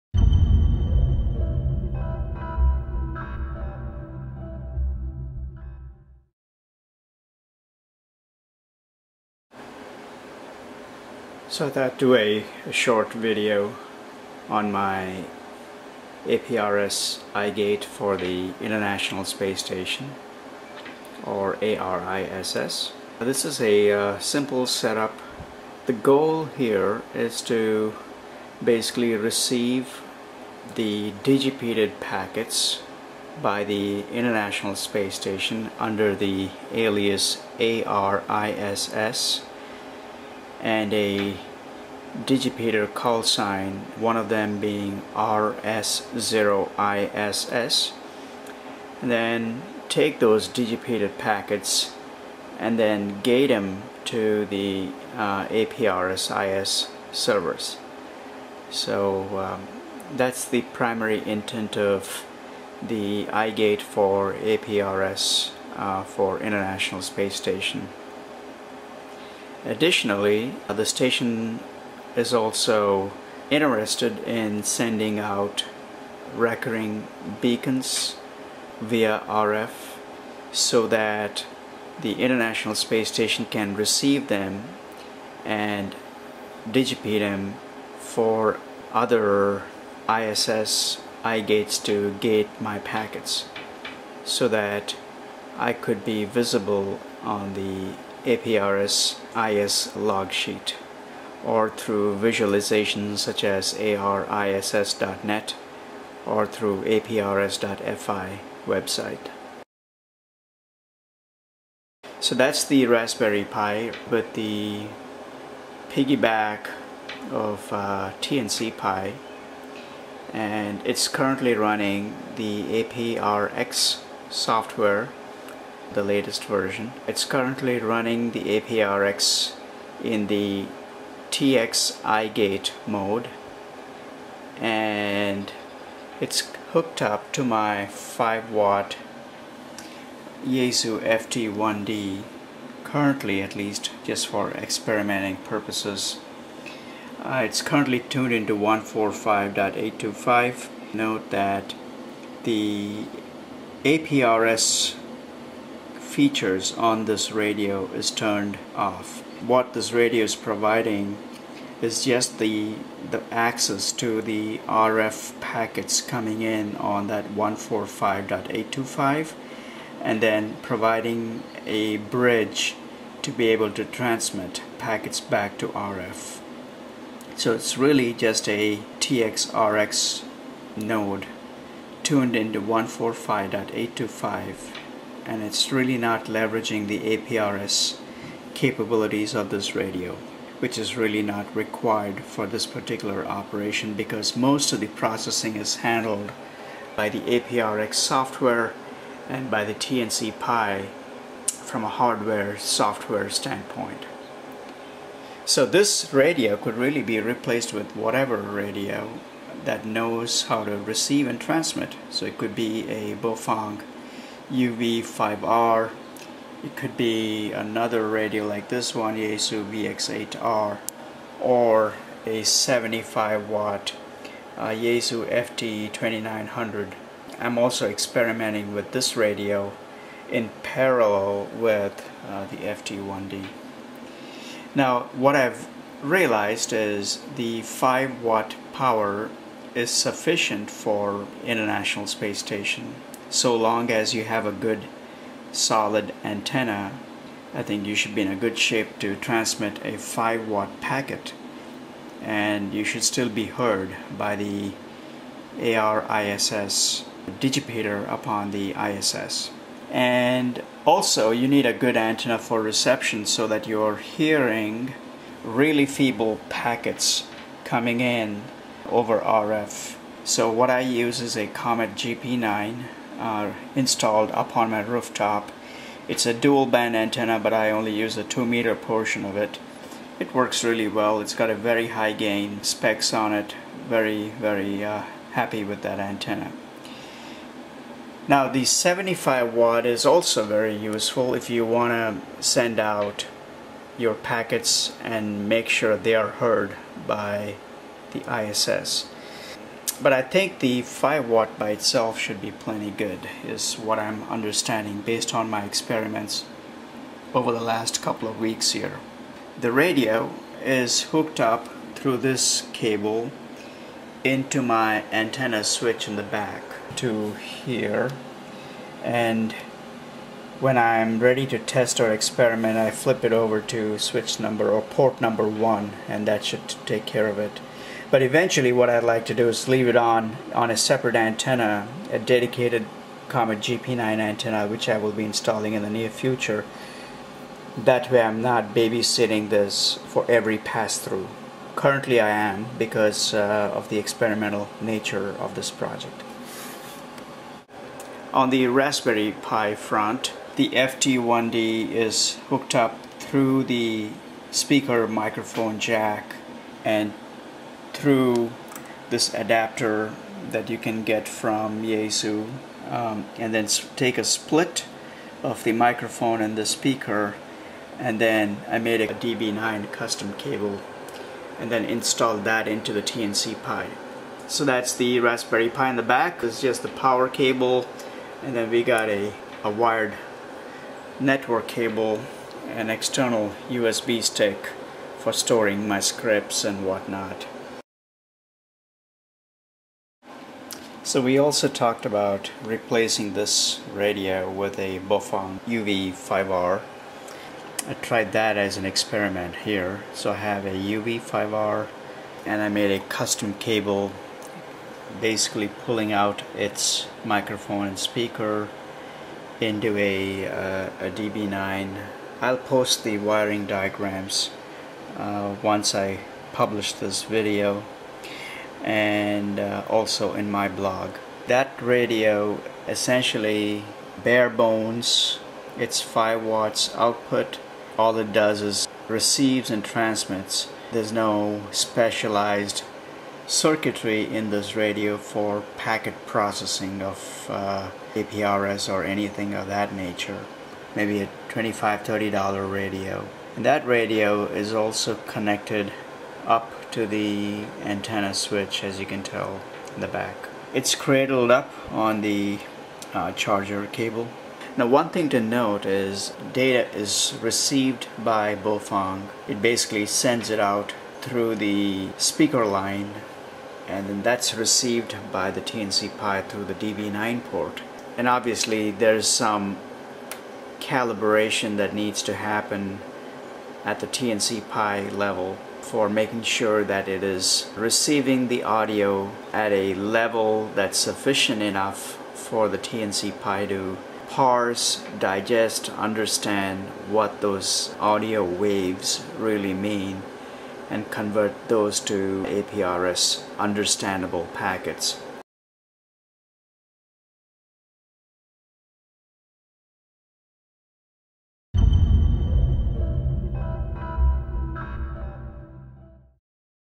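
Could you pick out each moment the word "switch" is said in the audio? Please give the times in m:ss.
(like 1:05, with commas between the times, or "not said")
5:15, 5:23, 7:28.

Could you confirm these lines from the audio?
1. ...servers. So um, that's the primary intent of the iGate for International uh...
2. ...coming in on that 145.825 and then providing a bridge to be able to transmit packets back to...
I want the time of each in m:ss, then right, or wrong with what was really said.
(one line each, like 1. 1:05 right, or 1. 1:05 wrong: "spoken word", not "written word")
1. 0:57 wrong: "APRS", not "International"
2. 2:46 right.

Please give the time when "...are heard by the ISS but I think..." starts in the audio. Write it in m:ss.
4:56.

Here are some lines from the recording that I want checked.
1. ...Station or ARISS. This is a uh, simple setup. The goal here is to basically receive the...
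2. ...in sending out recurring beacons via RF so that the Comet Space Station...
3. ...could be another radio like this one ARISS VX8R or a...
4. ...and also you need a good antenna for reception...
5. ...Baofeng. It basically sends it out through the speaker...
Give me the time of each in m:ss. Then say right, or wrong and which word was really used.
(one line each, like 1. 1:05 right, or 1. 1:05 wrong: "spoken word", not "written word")
1. 0:19 right
2. 1:14 wrong: "International", not "Comet"
3. 3:36 wrong: "Yaesu", not "ARISS"
4. 4:19 right
5. 7:38 right.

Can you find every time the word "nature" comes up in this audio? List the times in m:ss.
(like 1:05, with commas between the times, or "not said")
5:44, 7:19.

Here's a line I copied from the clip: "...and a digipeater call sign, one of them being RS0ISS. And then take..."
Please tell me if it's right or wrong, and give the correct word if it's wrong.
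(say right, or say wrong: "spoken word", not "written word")
right.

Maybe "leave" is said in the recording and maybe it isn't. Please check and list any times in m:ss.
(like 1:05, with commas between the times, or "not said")
5:29.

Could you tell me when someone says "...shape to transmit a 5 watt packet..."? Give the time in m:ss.
4:08.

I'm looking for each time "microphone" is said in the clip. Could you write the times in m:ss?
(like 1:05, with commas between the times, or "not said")
5:55, 6:05, 6:47.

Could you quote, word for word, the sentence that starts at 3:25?
So this radio could really be replaced with whatever radio that knows how to receive and transmit.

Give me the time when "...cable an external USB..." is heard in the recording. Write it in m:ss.
6:21.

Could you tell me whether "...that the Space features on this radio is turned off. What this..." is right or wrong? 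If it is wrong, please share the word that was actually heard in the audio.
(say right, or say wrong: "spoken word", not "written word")
wrong: "APRS", not "Space".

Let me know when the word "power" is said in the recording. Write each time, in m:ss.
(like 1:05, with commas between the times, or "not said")
3:58, 6:16.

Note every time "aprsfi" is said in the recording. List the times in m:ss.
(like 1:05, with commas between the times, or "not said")
1:46.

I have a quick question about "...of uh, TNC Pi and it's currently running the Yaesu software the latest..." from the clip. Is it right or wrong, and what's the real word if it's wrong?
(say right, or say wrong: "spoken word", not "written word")
wrong: "APRX", not "Yaesu".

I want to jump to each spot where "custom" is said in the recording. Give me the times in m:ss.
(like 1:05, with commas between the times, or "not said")
6:09, 6:43.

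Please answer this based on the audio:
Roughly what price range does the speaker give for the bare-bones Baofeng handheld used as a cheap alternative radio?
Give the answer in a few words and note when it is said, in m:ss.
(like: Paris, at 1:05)
$25 to $30, at 7:21.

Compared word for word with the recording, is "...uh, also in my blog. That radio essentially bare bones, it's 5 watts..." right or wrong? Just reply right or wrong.
right.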